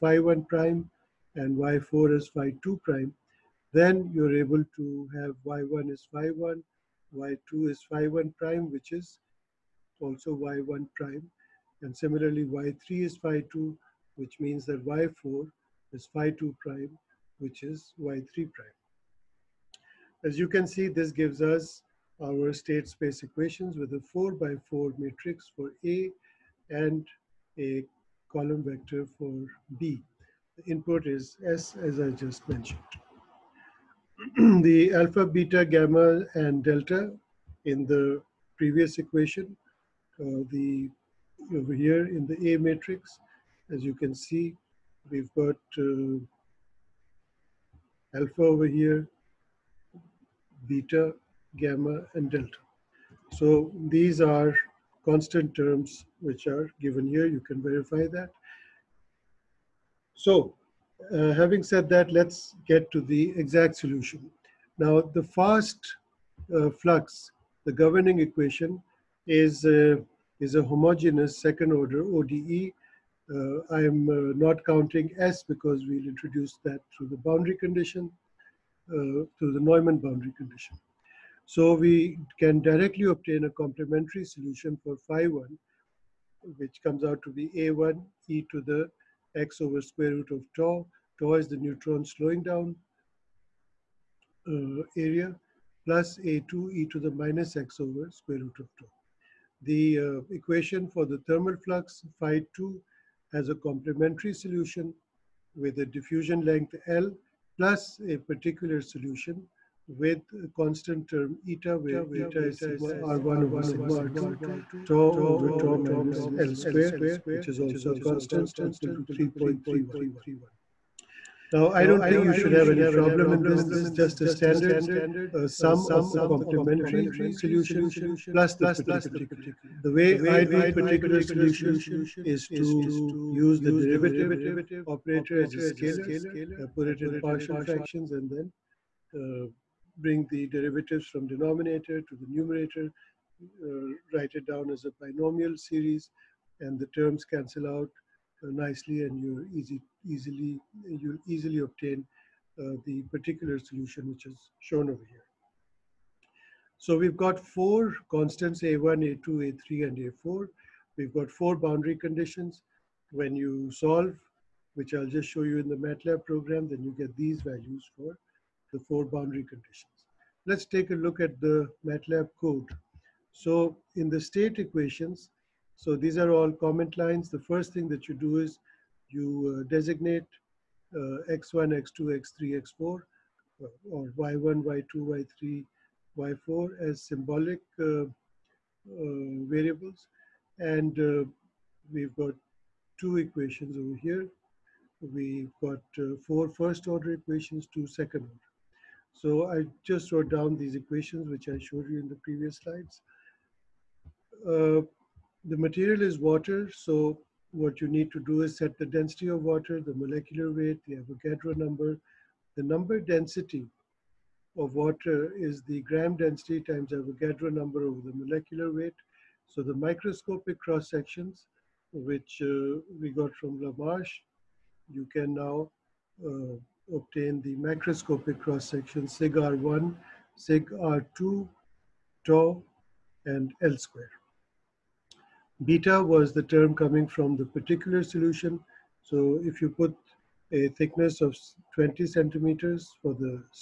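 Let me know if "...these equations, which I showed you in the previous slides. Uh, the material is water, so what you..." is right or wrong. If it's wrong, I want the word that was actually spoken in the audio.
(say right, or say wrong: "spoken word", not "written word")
right.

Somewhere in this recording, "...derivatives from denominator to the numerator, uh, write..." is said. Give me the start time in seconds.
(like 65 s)
140 s.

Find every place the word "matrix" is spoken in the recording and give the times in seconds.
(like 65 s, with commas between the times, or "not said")
24 s, 42 s.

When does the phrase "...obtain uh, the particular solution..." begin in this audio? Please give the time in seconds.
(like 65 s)
151 s.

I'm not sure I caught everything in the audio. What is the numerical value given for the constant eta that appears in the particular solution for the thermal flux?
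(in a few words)
3.31.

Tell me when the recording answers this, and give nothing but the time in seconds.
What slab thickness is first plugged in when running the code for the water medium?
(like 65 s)
241 s.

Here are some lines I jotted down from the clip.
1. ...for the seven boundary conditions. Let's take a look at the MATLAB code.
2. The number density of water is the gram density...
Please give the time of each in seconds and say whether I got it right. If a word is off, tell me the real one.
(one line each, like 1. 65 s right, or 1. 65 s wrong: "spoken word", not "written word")
1. 167 s wrong: "four", not "seven"
2. 212 s right.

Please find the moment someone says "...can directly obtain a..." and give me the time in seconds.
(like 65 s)
82 s.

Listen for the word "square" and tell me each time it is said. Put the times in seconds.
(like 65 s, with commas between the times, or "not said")
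89 s, 98 s, 116 s, 233 s.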